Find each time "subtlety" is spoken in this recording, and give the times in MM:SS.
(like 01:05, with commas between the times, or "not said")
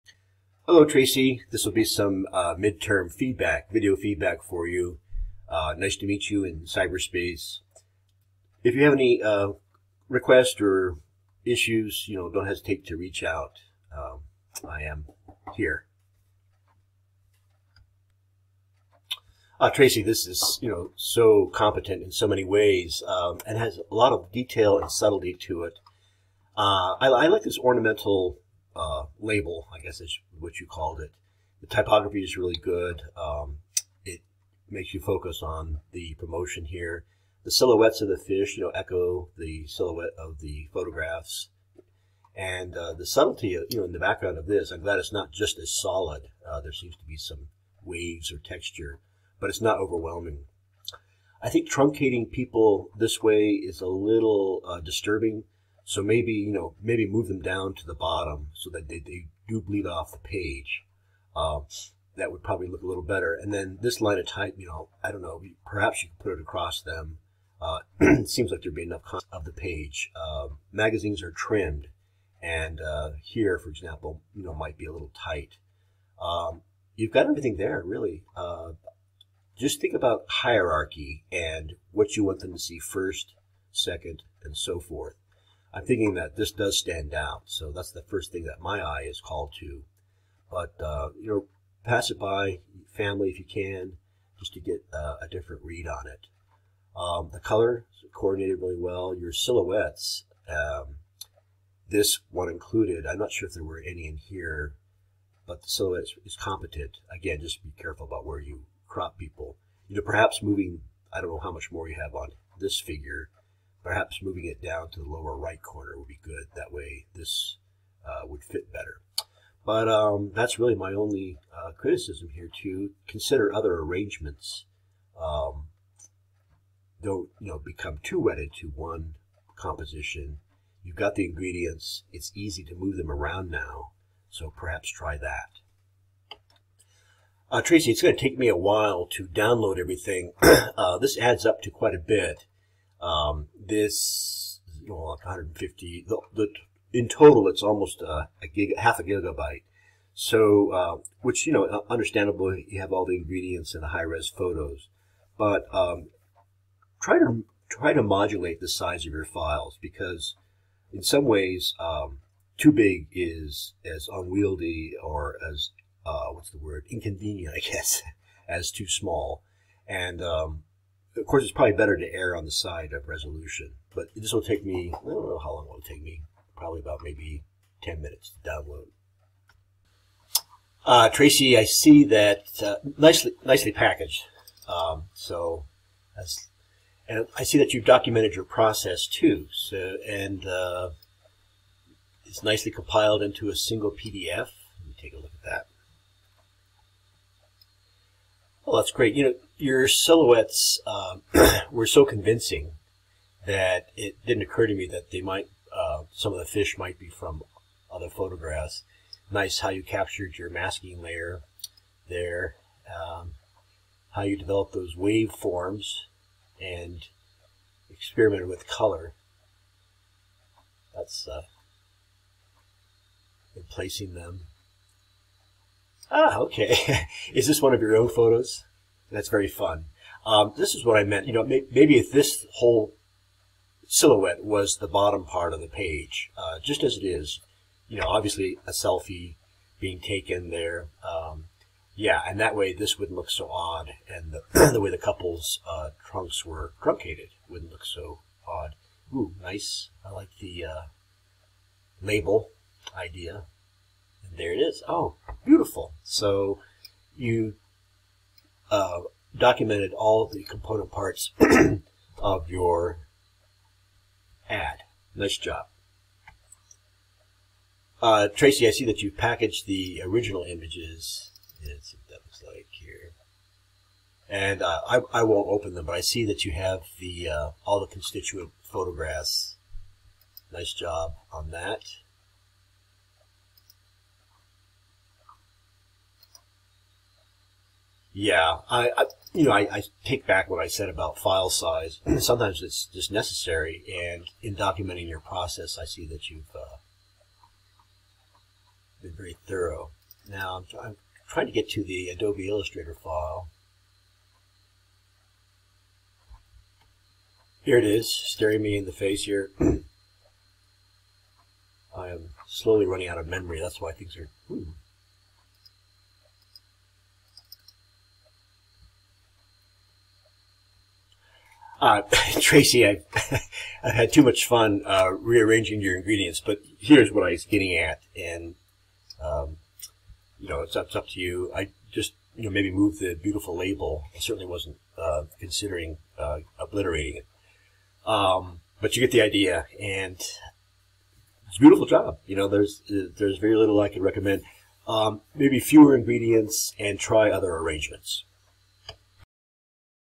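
00:24, 00:43.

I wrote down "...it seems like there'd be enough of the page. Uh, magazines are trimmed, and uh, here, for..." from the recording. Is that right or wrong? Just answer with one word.
right.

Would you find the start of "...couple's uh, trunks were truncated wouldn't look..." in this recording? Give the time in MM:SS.
04:04.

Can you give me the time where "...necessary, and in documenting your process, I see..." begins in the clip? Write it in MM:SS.
04:53.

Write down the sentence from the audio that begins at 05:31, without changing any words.
I just you know maybe move the beautiful label.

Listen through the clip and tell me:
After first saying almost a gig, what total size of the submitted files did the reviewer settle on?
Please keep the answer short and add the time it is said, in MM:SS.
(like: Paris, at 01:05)
half a gigabyte, at 02:28.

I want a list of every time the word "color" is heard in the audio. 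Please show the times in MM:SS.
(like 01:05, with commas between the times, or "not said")
01:37, 03:38.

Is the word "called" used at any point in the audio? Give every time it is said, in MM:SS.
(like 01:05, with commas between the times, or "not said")
00:30, 01:29.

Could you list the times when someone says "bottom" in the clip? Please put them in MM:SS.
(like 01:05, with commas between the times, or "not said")
00:57, 03:54.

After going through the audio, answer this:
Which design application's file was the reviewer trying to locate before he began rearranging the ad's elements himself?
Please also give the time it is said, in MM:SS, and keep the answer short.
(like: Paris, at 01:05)
Adobe Illustrator, at 05:02.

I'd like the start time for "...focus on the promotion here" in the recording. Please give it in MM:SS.
00:34.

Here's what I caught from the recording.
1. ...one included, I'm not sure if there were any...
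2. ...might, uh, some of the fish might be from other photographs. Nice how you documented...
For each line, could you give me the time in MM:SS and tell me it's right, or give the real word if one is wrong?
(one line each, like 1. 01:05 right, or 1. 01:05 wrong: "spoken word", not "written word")
1. 01:42 right
2. 03:25 wrong: "captured", not "documented".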